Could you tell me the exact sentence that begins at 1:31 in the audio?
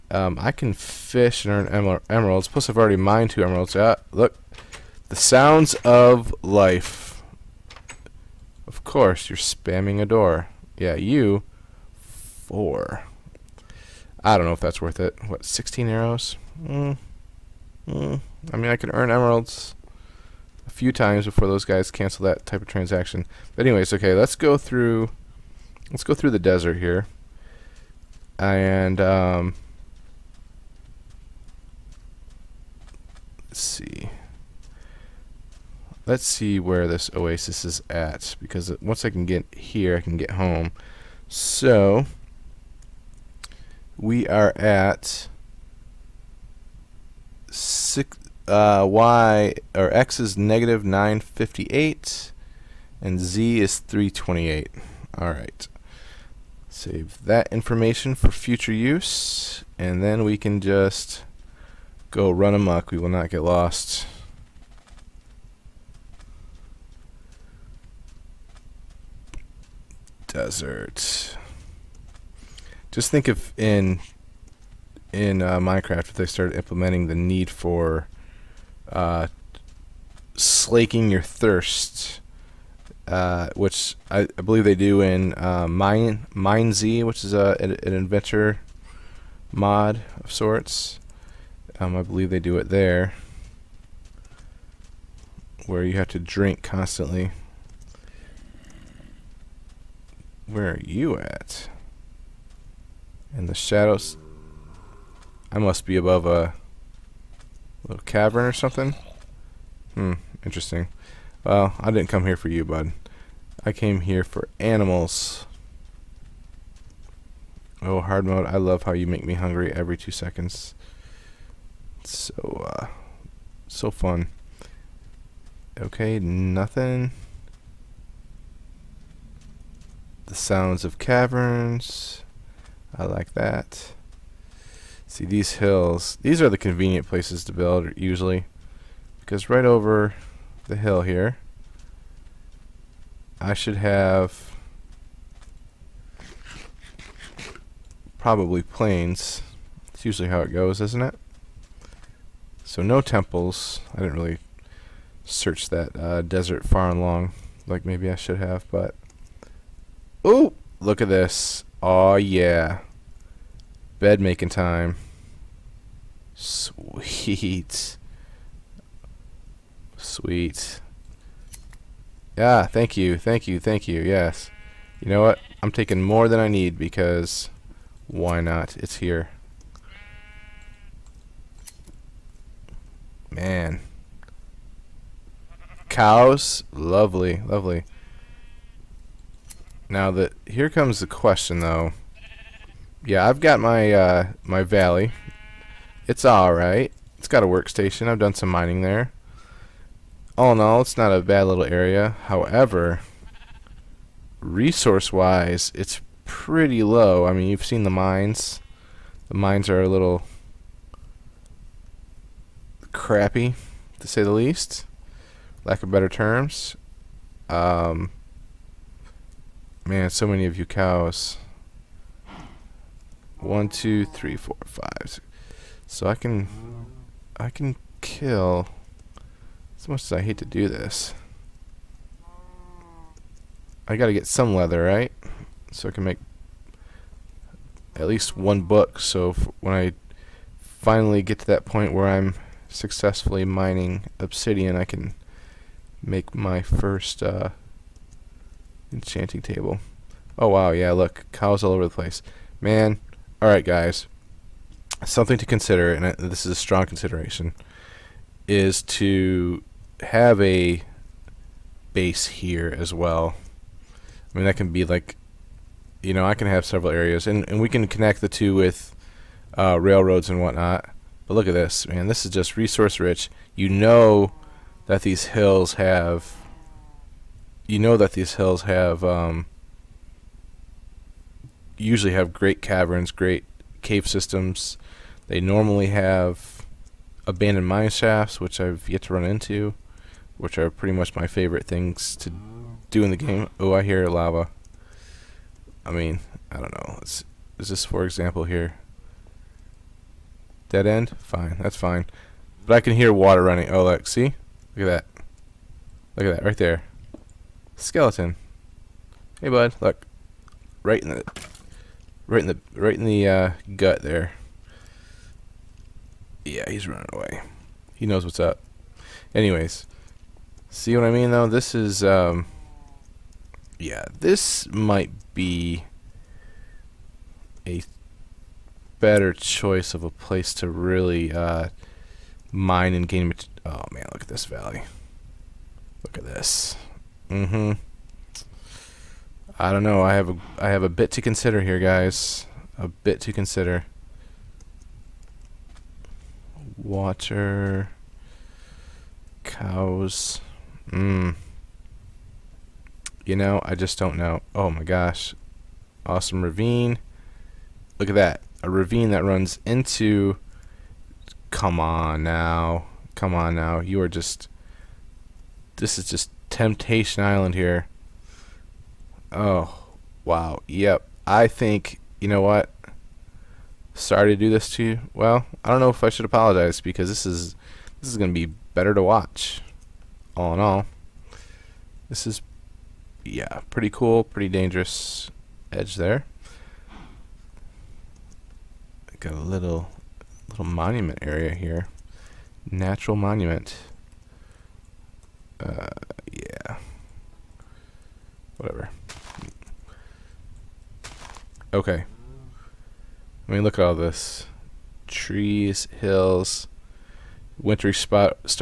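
Um, I believe they do it there, where you have to drink constantly.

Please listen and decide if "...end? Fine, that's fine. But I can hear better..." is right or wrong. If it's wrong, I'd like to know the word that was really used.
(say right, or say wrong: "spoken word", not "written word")
wrong: "water", not "better".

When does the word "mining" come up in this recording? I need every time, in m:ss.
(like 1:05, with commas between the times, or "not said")
3:18, 4:03.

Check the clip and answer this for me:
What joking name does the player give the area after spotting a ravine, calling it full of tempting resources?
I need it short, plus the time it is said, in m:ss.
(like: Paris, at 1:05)
Temptation Island, at 6:06.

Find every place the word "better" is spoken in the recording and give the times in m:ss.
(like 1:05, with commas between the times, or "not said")
3:35, 5:28, 6:18.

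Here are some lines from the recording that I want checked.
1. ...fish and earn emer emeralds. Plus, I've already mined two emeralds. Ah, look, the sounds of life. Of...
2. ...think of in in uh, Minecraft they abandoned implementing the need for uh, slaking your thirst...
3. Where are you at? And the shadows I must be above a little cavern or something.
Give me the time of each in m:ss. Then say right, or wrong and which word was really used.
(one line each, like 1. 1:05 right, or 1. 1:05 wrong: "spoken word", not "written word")
1. 0:00 right
2. 1:13 wrong: "started", not "abandoned"
3. 1:40 right.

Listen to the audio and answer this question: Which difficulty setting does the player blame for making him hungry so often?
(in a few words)
hard mode.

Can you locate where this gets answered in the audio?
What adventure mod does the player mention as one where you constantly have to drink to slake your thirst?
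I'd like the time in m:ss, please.
1:25.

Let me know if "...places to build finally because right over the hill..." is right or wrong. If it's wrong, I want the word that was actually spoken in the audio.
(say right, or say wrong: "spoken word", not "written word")
wrong: "usually", not "finally".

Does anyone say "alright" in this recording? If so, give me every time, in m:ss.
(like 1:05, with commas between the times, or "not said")
3:16, 4:13.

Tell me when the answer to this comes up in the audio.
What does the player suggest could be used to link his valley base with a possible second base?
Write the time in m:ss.
4:29.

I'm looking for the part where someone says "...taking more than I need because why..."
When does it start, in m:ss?
2:55.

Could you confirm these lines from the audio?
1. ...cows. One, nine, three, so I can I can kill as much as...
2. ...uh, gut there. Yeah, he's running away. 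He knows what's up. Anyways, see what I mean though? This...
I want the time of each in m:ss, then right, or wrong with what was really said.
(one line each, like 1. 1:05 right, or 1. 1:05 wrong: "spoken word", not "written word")
1. 3:40 wrong: "two", not "nine"
2. 5:13 right.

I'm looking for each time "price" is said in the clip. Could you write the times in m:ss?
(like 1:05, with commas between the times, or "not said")
not said.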